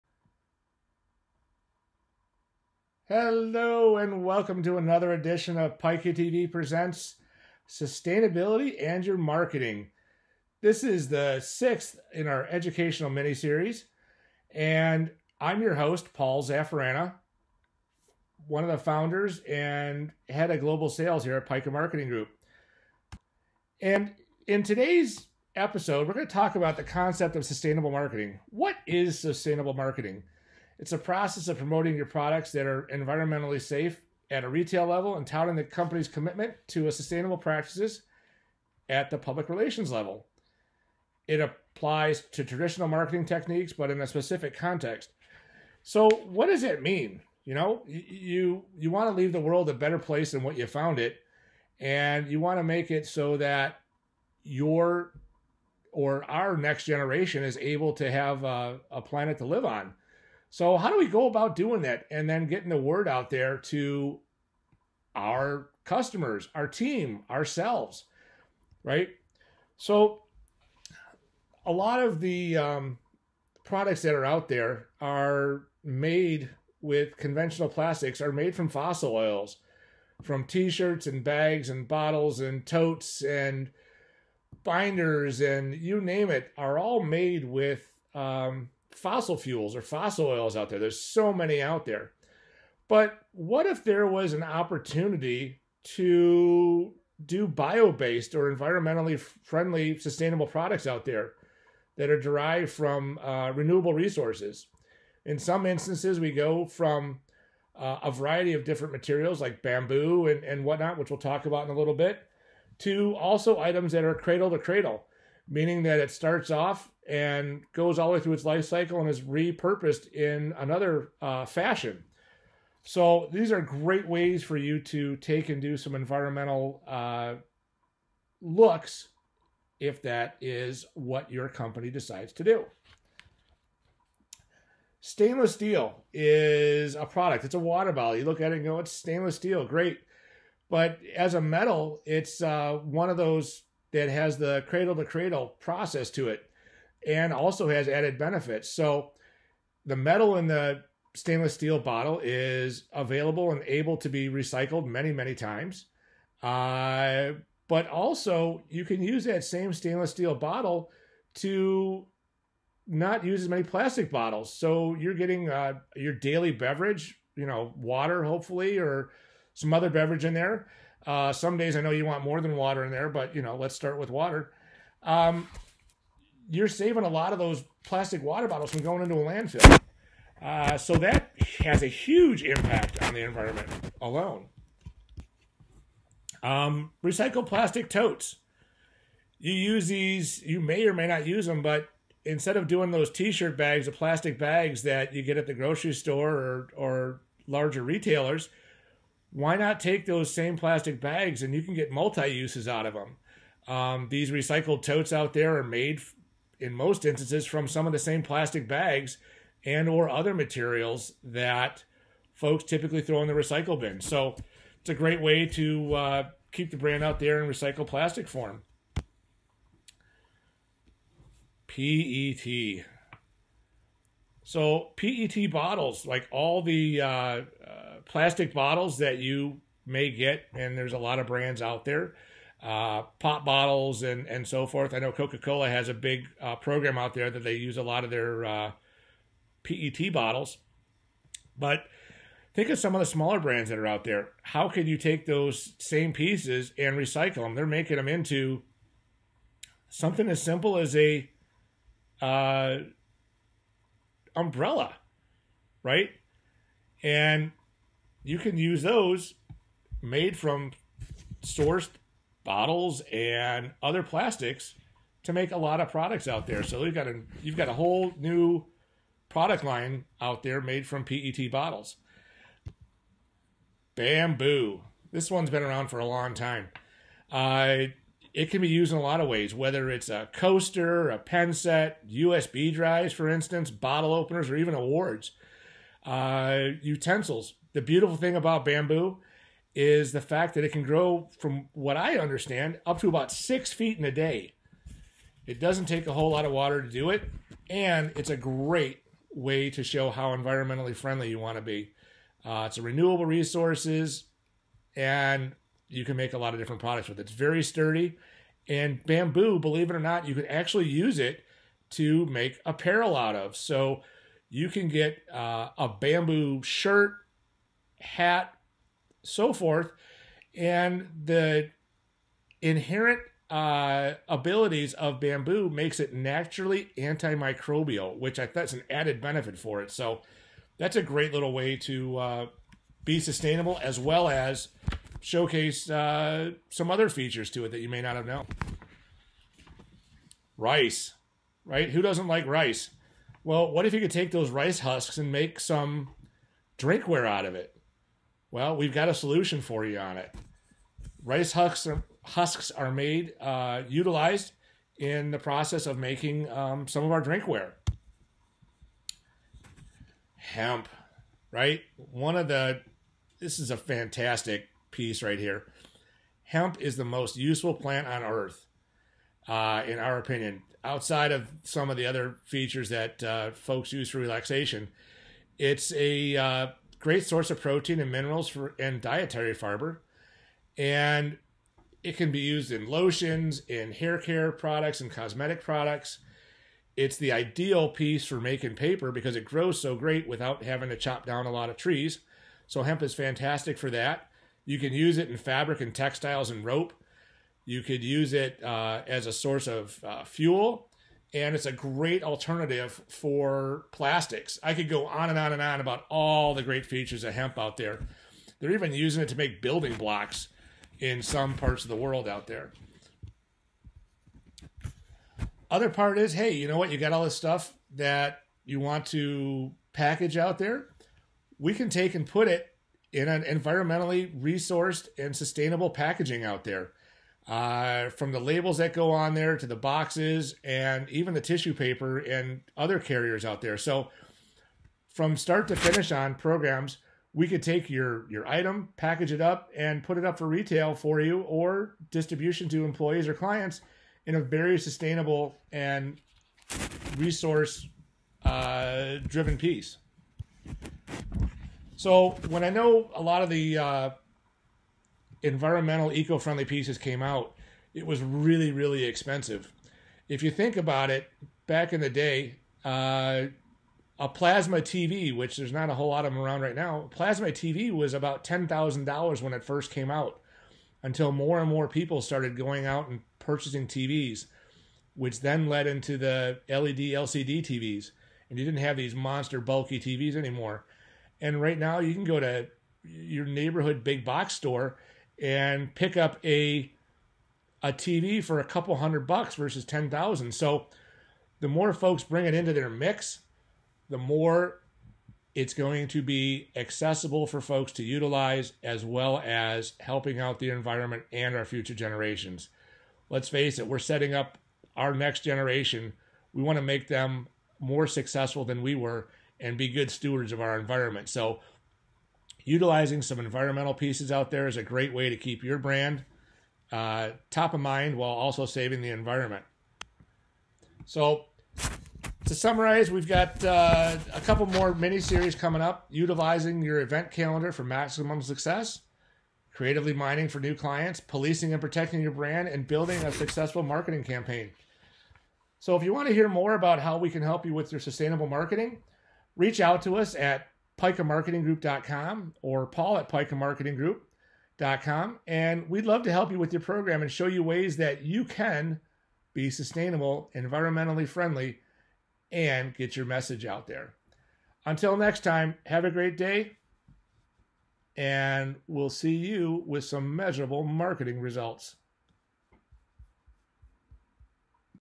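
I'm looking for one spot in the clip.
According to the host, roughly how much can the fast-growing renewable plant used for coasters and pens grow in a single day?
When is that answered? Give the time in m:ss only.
4:53.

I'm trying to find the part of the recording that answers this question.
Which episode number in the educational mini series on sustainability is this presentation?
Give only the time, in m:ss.
0:11.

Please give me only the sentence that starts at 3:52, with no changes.
Uh, pop bottles and and so forth.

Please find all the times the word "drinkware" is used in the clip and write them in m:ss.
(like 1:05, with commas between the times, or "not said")
5:46, 5:57.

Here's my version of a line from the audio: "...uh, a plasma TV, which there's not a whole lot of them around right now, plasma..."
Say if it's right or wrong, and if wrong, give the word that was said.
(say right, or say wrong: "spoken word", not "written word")
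right.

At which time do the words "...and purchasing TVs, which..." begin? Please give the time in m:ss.
7:53.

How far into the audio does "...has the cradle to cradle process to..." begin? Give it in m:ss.
2:24.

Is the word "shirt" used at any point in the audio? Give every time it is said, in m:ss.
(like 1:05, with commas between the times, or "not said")
1:20, 3:13, 5:16.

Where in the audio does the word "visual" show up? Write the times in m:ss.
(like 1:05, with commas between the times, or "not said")
not said.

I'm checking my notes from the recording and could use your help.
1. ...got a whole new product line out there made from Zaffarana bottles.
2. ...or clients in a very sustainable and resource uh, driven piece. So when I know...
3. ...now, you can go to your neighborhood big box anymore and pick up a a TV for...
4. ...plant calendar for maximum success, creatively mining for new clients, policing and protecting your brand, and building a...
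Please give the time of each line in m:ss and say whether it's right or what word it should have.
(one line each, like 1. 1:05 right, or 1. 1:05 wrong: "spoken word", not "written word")
1. 4:27 wrong: "PET", not "Zaffarana"
2. 7:23 right
3. 8:01 wrong: "store", not "anymore"
4. 8:46 wrong: "event", not "plant".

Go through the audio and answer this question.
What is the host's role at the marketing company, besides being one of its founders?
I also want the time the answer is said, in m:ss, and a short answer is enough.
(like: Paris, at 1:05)
head of global sales, at 0:20.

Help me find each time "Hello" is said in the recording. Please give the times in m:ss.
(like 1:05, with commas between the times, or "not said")
0:03.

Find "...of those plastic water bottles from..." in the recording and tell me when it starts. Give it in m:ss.
2:57.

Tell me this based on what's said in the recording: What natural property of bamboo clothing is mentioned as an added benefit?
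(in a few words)
antimicrobial.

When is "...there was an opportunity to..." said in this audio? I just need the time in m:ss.
1:33.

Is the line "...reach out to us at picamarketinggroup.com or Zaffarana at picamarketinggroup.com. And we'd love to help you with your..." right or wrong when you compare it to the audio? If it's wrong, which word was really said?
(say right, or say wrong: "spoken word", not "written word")
wrong: "Paul", not "Zaffarana".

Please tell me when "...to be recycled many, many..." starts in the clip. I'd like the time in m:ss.
2:33.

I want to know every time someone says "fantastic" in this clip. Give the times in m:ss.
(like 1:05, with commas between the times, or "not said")
6:03, 6:33.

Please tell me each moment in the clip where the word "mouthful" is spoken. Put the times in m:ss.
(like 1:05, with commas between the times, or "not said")
not said.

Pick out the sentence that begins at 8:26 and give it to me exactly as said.
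We want to make them more successful than we were and be good stewards of our environment.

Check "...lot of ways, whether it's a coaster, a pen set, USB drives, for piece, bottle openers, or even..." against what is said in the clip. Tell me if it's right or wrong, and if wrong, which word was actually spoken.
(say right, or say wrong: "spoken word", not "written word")
wrong: "instance", not "piece".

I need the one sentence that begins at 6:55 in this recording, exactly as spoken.
Other part is, hey, you know what?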